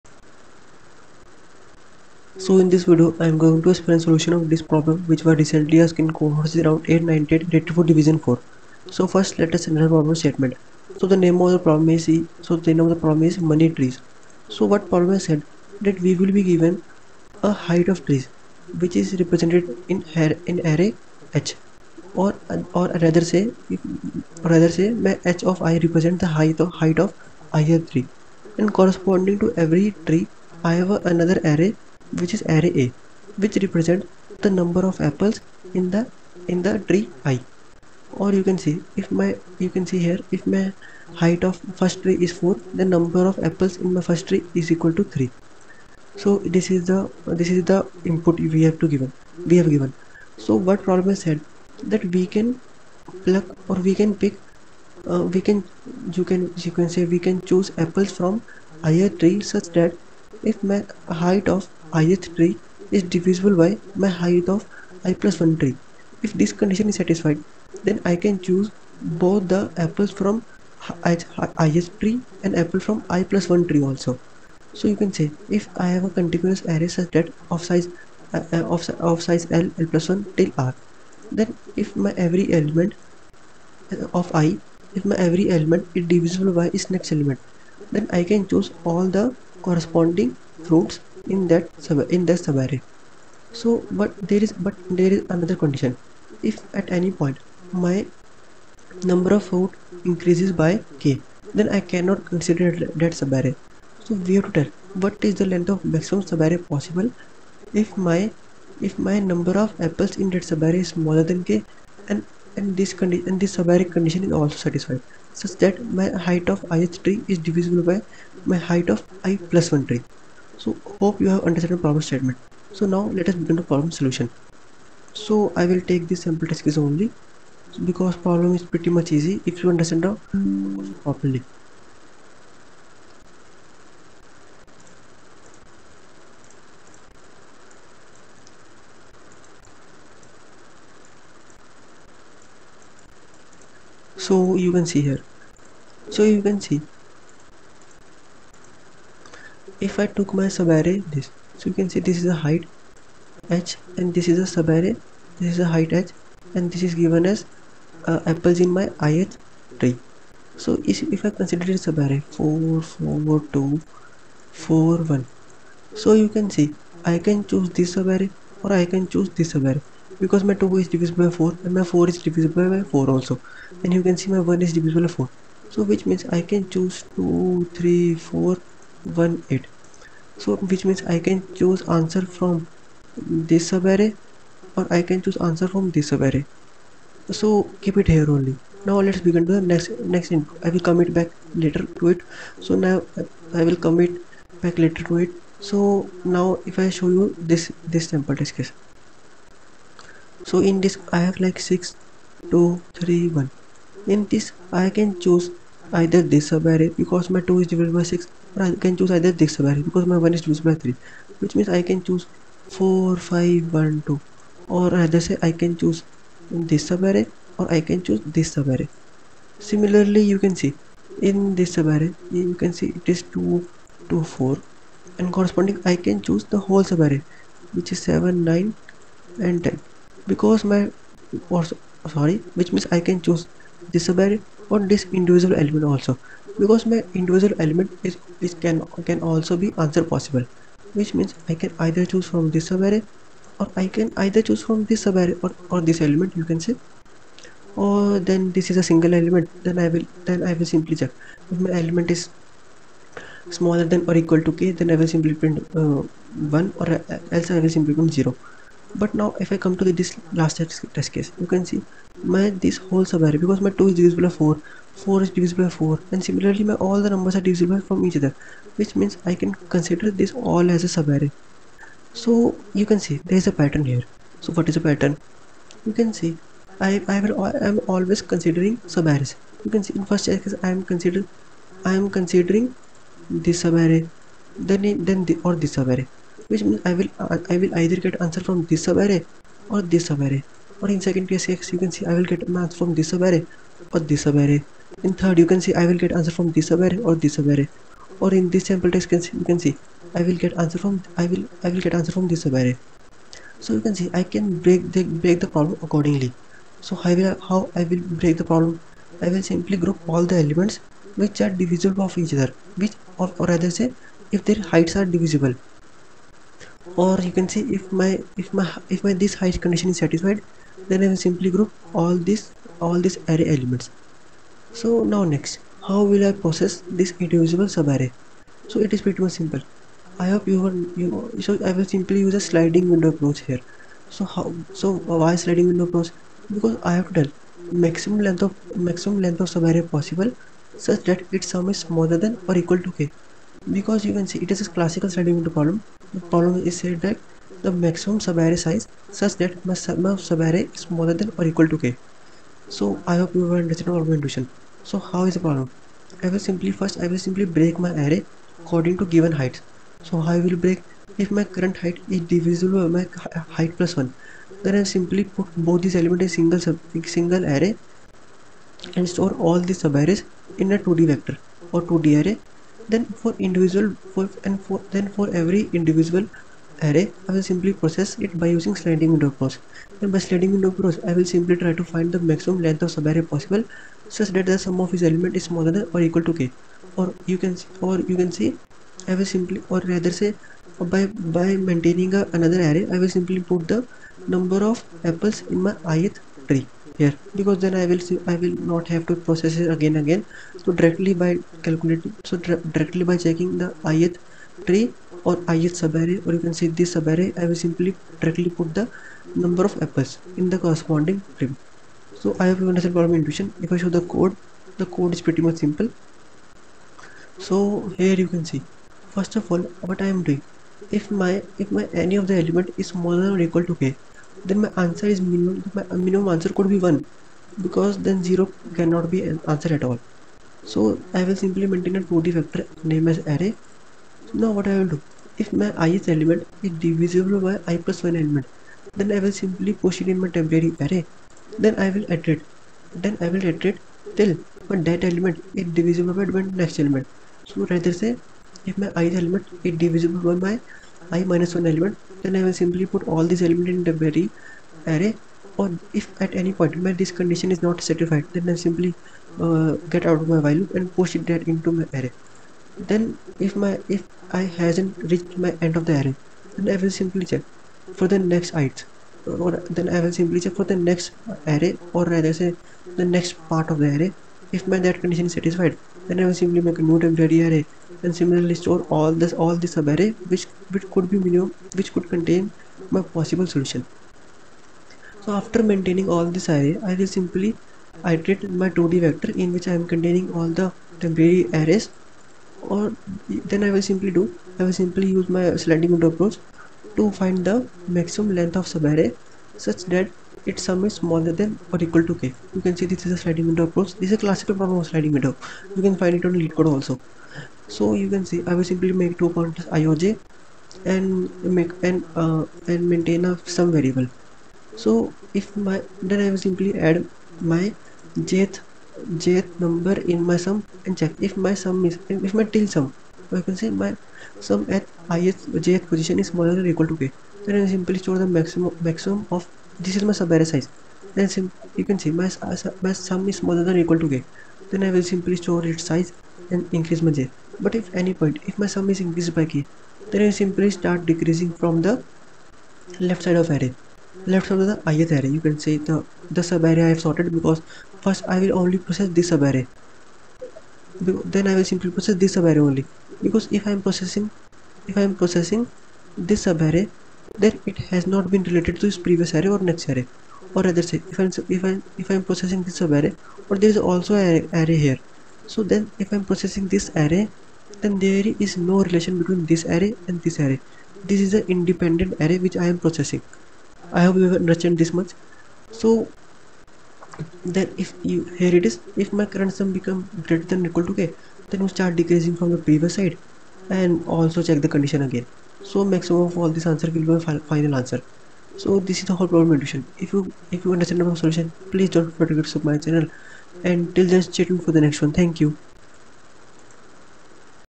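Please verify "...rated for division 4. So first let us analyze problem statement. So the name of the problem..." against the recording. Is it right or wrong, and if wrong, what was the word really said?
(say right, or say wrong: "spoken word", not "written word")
right.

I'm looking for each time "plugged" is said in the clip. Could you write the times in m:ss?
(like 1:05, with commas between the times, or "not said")
not said.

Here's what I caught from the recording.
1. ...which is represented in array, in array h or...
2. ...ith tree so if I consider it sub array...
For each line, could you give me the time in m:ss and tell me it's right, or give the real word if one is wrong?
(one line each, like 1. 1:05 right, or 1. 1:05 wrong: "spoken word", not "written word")
1. 0:18 right
2. 2:39 right.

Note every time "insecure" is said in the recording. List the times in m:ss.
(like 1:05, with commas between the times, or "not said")
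not said.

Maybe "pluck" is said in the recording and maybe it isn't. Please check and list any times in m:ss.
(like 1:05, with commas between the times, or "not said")
0:53.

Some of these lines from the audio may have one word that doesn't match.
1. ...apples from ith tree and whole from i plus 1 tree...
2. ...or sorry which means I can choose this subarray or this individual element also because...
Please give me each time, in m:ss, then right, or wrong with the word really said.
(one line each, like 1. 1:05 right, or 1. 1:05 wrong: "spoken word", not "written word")
1. 1:09 wrong: "apple", not "whole"
2. 3:51 right.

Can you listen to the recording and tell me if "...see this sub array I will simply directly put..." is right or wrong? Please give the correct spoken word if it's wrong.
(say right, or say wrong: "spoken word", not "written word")
right.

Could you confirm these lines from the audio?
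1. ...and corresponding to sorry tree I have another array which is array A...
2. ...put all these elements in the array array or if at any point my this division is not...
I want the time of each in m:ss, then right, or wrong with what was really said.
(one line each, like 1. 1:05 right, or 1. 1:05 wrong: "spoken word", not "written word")
1. 0:28 wrong: "every", not "sorry"
2. 7:32 wrong: "condition", not "division".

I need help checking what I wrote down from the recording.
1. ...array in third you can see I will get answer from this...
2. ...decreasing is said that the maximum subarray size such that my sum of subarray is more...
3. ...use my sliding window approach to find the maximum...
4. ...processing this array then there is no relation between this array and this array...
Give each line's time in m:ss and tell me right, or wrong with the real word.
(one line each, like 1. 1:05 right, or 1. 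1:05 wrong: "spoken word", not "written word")
1. 4:54 right
2. 5:46 wrong: "following", not "decreasing"
3. 8:15 right
4. 9:26 right.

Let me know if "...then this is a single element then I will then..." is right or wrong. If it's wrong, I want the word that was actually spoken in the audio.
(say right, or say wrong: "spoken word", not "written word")
right.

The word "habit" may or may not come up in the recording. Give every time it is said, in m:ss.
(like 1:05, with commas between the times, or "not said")
not said.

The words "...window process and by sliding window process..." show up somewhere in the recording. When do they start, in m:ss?
6:19.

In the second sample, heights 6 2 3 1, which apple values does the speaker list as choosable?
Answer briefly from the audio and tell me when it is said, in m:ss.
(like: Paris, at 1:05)
4 5 1 2, at 3:32.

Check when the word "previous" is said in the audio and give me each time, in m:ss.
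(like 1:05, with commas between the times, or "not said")
9:18, 9:42.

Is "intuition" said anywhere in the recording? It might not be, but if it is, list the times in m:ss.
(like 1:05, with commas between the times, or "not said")
5:54, 6:53.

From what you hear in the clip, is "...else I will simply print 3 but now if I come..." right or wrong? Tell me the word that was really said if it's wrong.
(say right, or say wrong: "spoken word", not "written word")
wrong: "0", not "3".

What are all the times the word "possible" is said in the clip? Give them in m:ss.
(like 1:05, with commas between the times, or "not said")
1:46, 4:00, 5:39, 6:23, 8:03.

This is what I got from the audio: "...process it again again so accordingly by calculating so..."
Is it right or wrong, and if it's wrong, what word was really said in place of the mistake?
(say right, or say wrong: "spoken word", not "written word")
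wrong: "directly", not "accordingly".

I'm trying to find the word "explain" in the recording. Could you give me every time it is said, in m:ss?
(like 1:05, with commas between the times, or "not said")
0:03.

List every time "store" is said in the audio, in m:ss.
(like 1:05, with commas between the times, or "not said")
6:09, 7:58, 8:47, 8:55.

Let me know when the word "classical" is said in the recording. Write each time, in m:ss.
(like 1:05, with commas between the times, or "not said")
5:44, 8:24.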